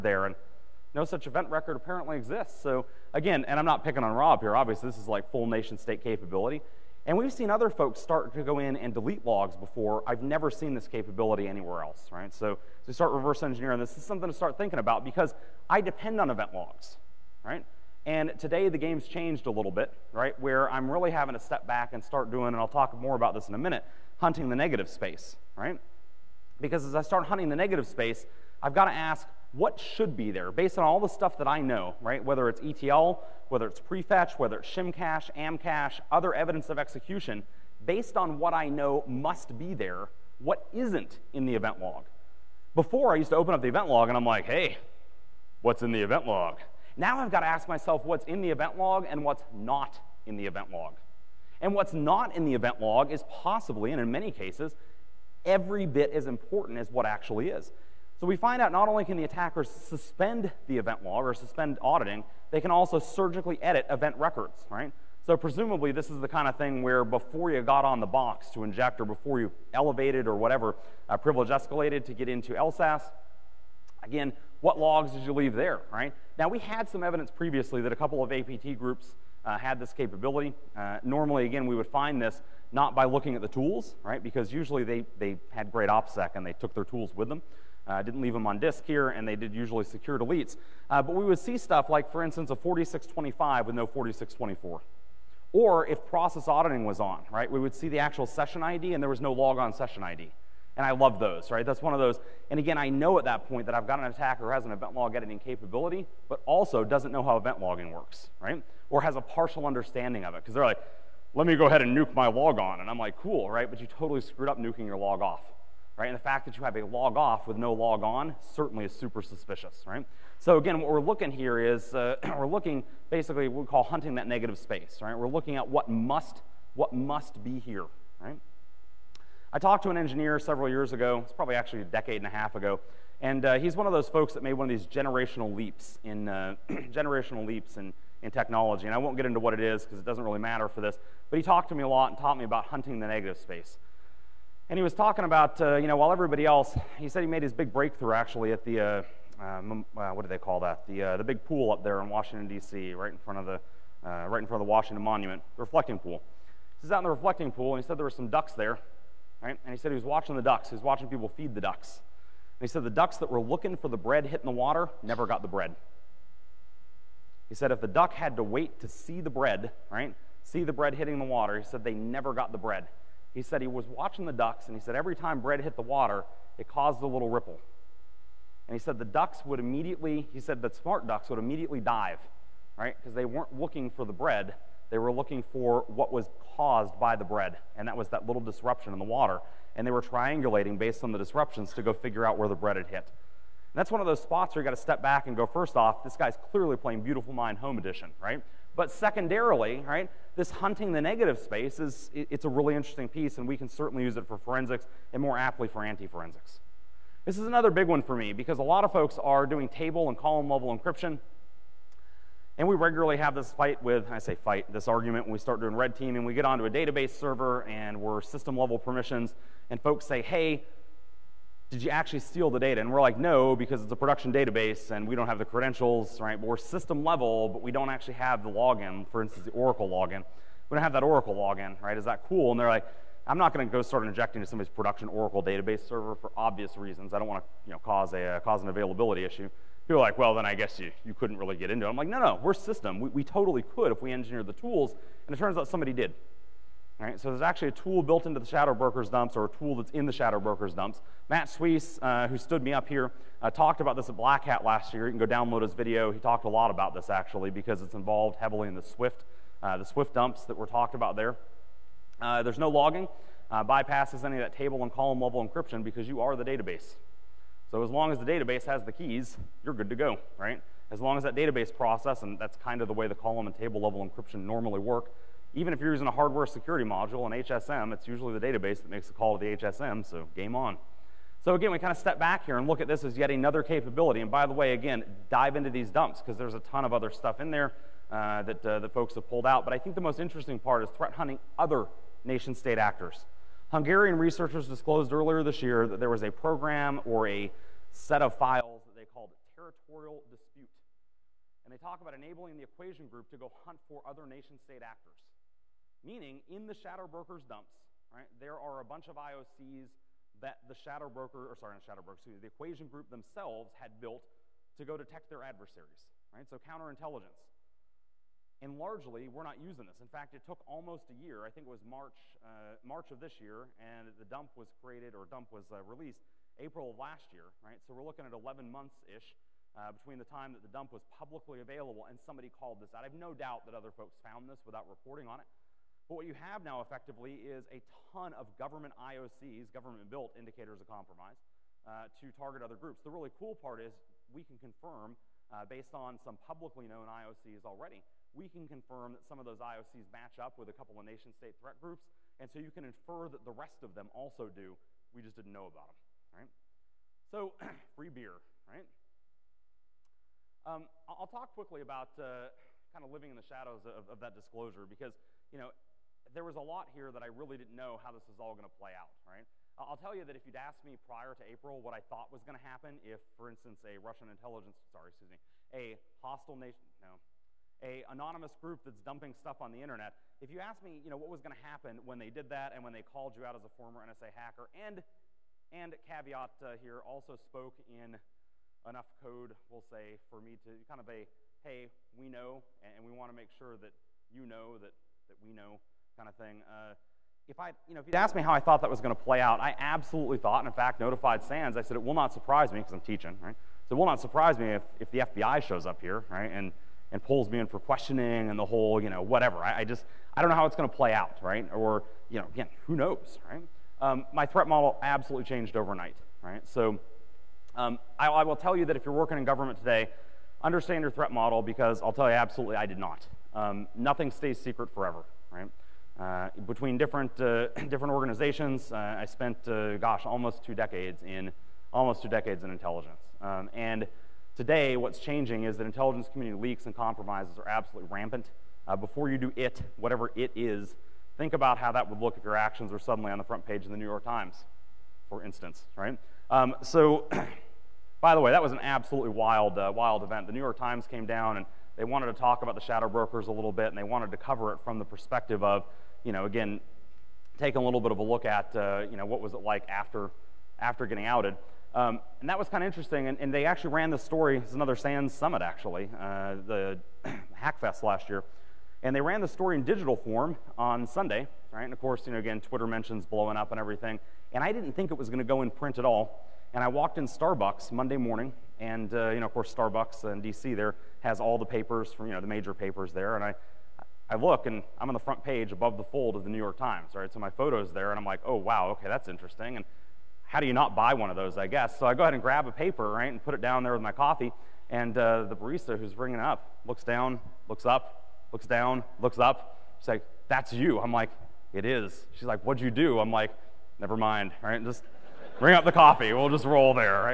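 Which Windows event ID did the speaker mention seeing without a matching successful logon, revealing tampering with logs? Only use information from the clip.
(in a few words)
4625.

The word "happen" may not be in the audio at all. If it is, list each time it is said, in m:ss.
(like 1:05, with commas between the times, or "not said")
6:12, 6:21.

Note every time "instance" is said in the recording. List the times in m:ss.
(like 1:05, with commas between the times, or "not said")
1:32, 3:49, 6:13, 7:25.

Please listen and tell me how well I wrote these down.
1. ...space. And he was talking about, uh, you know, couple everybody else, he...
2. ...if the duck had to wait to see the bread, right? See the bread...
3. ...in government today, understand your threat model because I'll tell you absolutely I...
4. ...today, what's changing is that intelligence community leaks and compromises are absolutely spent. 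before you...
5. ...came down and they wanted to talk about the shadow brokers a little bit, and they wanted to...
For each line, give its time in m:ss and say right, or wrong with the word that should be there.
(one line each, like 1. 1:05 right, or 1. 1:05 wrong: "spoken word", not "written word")
1. 2:23 wrong: "while", not "couple"
2. 2:47 right
3. 6:59 right
4. 7:14 wrong: "rampant", not "spent"
5. 7:31 right.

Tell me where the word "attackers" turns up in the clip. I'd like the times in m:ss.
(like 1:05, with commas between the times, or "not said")
0:59, 1:44.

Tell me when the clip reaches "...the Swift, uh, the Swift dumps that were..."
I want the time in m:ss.
4:18.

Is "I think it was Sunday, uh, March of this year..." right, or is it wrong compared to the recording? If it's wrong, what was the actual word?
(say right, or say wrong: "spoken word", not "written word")
wrong: "March", not "Sunday".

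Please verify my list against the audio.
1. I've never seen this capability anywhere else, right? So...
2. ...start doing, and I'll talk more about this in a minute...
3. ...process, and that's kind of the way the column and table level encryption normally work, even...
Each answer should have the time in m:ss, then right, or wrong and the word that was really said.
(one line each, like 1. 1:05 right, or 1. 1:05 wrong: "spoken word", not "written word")
1. 0:10 right
2. 0:22 right
3. 4:31 right.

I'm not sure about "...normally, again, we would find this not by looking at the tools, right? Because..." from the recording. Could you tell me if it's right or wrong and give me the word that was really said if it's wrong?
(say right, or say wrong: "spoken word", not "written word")
right.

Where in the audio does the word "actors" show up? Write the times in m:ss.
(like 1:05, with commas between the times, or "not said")
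4:52, 5:04.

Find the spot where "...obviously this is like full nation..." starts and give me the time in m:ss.
0:04.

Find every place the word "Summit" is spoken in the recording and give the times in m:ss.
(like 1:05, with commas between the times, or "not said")
7:45.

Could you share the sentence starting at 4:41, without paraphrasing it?
So again, we kind of step back here and look at this as yet another capability.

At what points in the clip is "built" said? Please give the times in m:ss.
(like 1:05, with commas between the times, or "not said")
4:08, 5:13, 5:40.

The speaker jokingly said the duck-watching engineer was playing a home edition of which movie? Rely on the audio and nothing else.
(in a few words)
Beautiful Mind.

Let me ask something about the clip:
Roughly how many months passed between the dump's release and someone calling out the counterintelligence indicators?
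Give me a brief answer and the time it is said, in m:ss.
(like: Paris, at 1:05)
11, at 5:28.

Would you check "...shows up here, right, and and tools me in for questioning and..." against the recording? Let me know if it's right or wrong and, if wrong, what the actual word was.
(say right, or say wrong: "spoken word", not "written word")
wrong: "pulls", not "tools".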